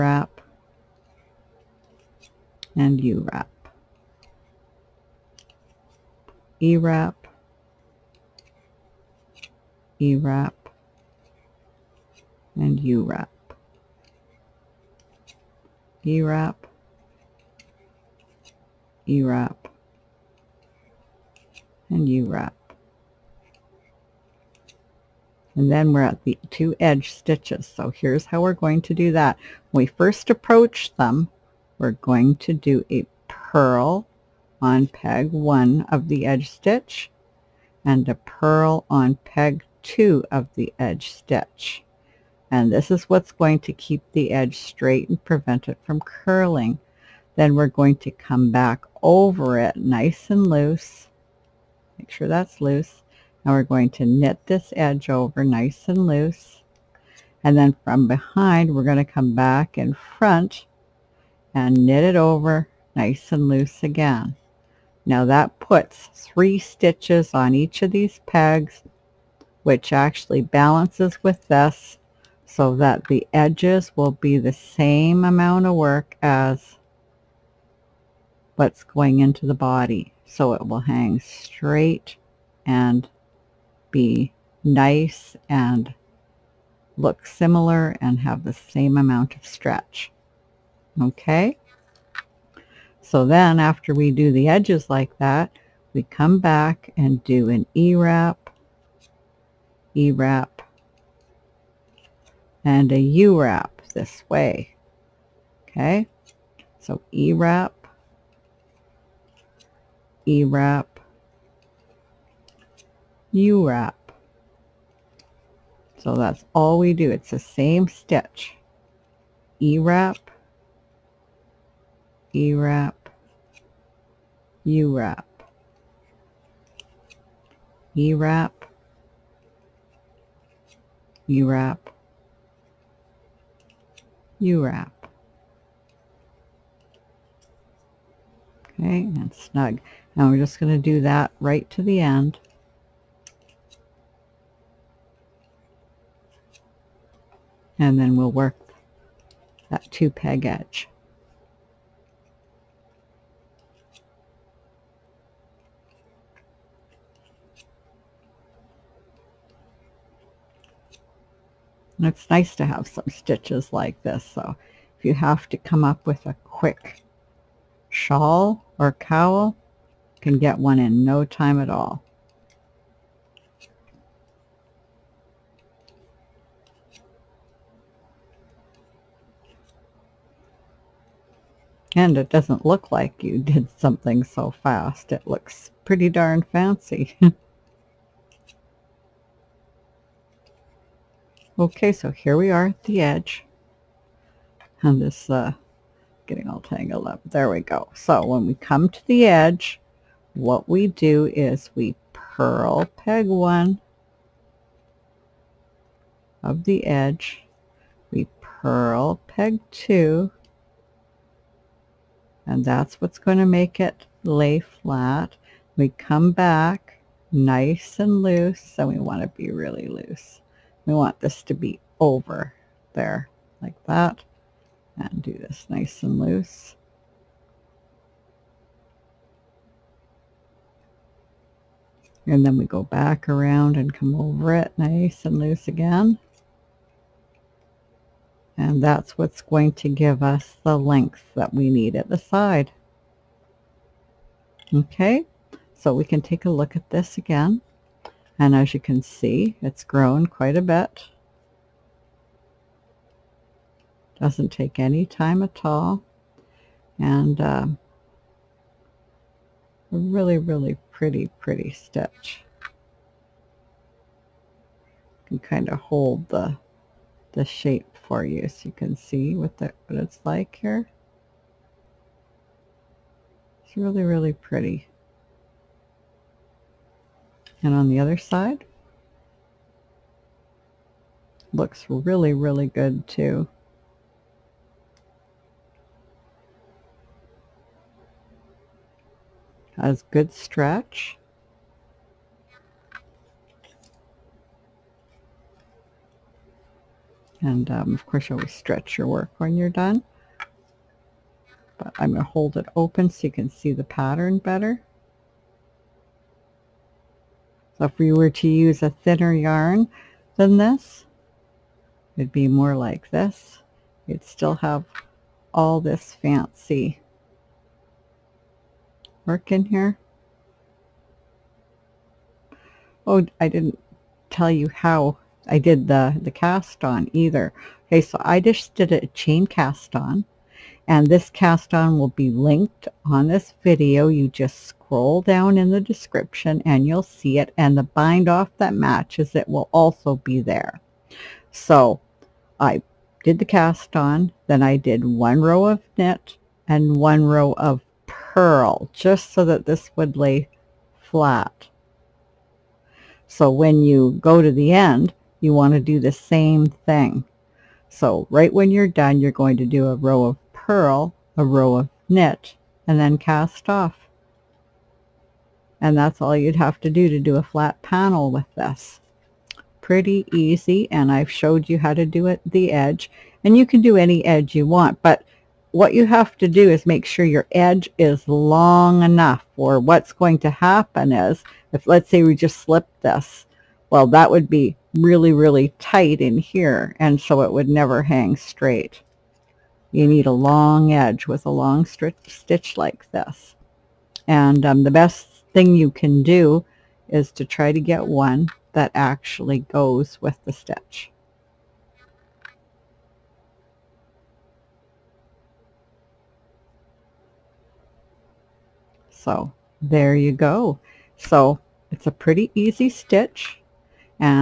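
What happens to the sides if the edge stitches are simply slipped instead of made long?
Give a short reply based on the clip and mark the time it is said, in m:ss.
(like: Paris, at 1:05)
Really tight, at 6:24.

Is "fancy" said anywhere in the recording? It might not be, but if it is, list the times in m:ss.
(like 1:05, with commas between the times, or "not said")
3:06, 5:16.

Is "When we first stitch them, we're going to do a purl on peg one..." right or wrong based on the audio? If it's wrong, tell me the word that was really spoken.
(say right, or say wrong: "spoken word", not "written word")
wrong: "approach", not "stitch".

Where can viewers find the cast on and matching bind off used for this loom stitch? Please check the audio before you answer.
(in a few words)
In the description.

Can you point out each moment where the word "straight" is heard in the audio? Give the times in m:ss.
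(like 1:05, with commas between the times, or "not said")
0:44, 1:21, 6:28.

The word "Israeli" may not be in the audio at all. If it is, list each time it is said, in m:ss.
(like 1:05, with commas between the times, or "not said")
not said.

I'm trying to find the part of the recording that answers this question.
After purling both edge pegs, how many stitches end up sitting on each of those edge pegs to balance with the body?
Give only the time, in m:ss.
1:06.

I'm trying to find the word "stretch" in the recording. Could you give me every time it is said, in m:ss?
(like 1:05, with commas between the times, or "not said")
1:29, 4:50, 4:58.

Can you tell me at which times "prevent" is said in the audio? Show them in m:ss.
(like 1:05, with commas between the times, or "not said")
0:45.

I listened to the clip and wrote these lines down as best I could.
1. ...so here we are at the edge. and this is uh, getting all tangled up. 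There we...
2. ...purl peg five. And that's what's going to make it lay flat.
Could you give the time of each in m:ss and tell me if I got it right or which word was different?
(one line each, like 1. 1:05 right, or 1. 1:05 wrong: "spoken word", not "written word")
1. 3:11 right
2. 3:28 wrong: "two", not "five".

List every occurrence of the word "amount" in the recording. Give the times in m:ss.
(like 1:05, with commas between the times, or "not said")
1:15, 1:28.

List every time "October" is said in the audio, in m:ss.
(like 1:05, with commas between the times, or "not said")
not said.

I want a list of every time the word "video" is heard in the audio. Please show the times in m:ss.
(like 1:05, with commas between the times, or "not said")
5:33.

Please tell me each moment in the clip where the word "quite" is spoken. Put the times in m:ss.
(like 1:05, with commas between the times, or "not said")
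4:10.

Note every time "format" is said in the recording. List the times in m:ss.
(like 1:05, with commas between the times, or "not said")
not said.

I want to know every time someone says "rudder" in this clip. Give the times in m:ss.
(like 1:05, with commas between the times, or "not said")
not said.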